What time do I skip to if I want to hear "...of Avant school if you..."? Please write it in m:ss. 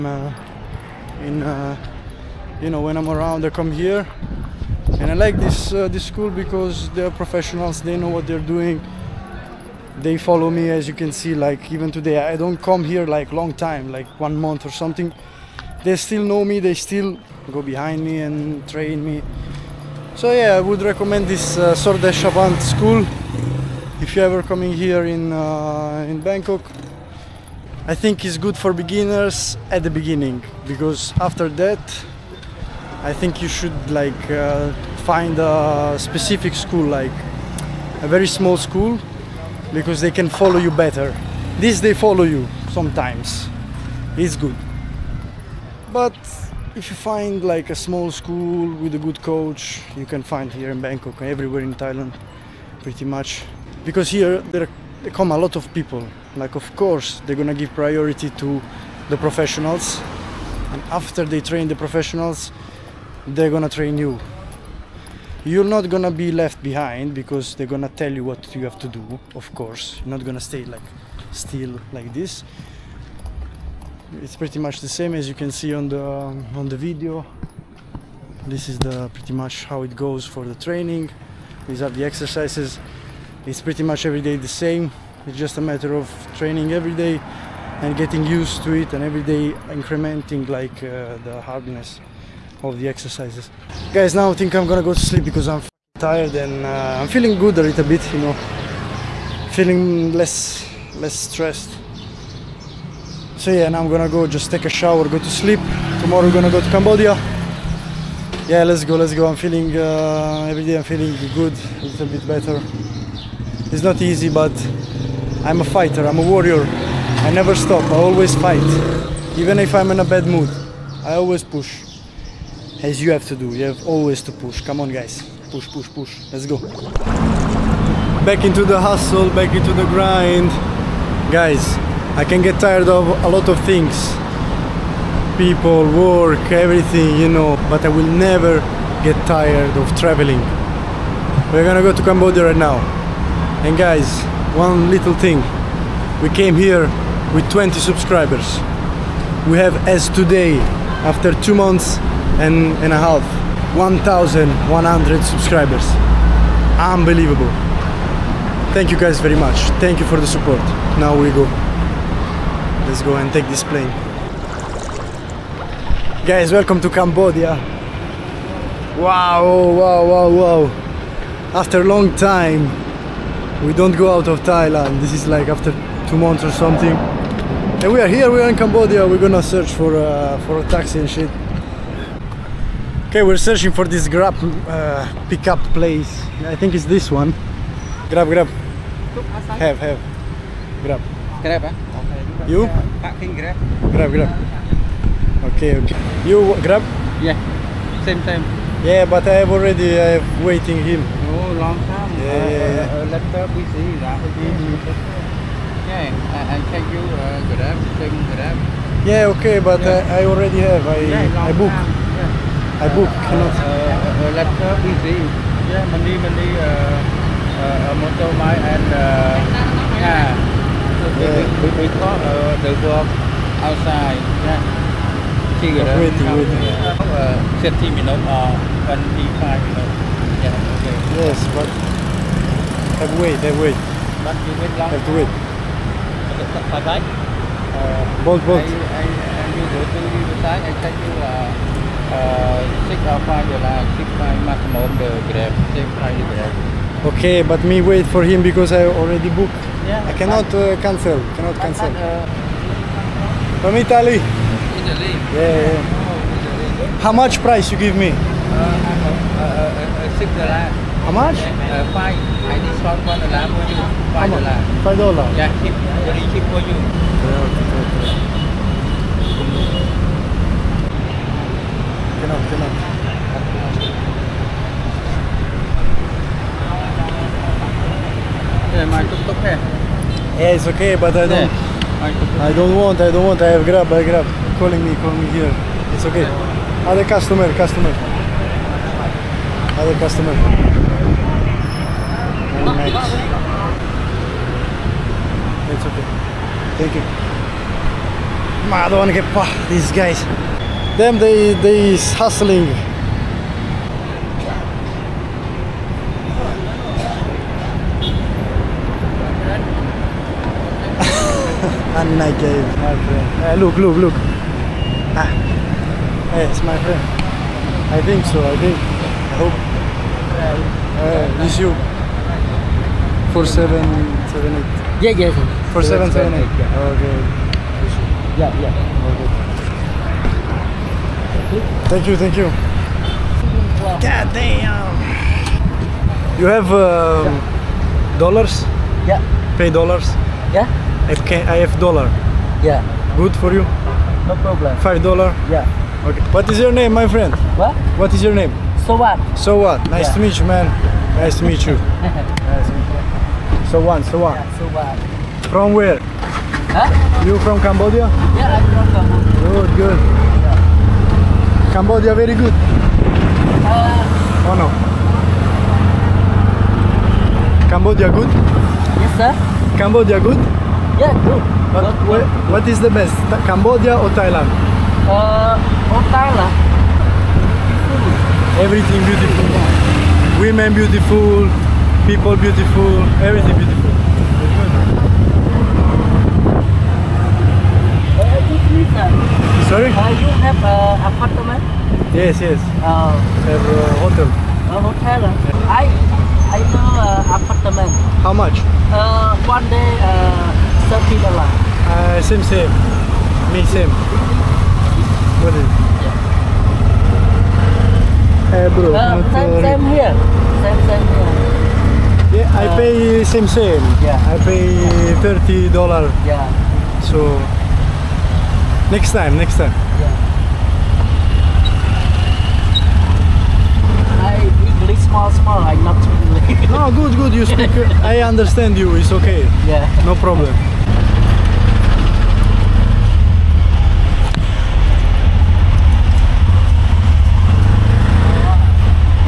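0:21.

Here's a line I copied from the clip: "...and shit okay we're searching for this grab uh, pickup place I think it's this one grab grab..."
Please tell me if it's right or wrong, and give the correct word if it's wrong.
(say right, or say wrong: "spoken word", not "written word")
right.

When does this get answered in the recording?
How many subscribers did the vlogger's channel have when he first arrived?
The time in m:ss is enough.
2:27.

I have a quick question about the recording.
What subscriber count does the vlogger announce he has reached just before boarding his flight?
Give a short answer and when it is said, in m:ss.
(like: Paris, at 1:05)
1,100, at 2:33.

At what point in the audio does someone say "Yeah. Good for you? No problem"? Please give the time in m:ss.
5:42.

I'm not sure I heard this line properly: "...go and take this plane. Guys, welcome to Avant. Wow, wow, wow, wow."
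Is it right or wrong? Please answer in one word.
wrong.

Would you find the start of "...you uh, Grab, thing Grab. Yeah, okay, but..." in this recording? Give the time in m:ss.
3:26.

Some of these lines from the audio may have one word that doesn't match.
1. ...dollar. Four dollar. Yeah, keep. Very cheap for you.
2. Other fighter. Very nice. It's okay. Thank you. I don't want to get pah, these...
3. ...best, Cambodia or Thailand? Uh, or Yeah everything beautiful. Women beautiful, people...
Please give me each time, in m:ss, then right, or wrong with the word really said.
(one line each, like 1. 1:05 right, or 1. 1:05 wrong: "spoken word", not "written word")
1. 4:24 wrong: "Five", not "Four"
2. 4:49 wrong: "customer", not "fighter"
3. 6:12 wrong: "Thailand", not "Yeah".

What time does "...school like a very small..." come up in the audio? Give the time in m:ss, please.
0:36.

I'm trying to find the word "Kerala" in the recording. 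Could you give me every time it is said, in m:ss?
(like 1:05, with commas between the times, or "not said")
not said.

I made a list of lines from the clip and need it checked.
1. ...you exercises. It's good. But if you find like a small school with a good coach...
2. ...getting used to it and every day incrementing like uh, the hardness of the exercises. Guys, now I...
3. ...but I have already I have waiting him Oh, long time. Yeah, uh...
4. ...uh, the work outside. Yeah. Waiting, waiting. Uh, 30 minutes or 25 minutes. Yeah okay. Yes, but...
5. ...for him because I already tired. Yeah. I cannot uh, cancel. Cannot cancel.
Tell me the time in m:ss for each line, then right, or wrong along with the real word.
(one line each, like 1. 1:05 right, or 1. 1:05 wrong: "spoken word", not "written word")
1. 0:42 wrong: "sometimes", not "exercises"
2. 1:27 right
3. 3:19 right
4. 3:42 right
5. 4:08 wrong: "booked", not "tired".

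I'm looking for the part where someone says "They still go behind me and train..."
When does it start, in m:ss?
0:16.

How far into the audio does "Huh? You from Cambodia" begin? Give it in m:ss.
5:56.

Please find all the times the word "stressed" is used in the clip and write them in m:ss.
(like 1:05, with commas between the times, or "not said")
1:41.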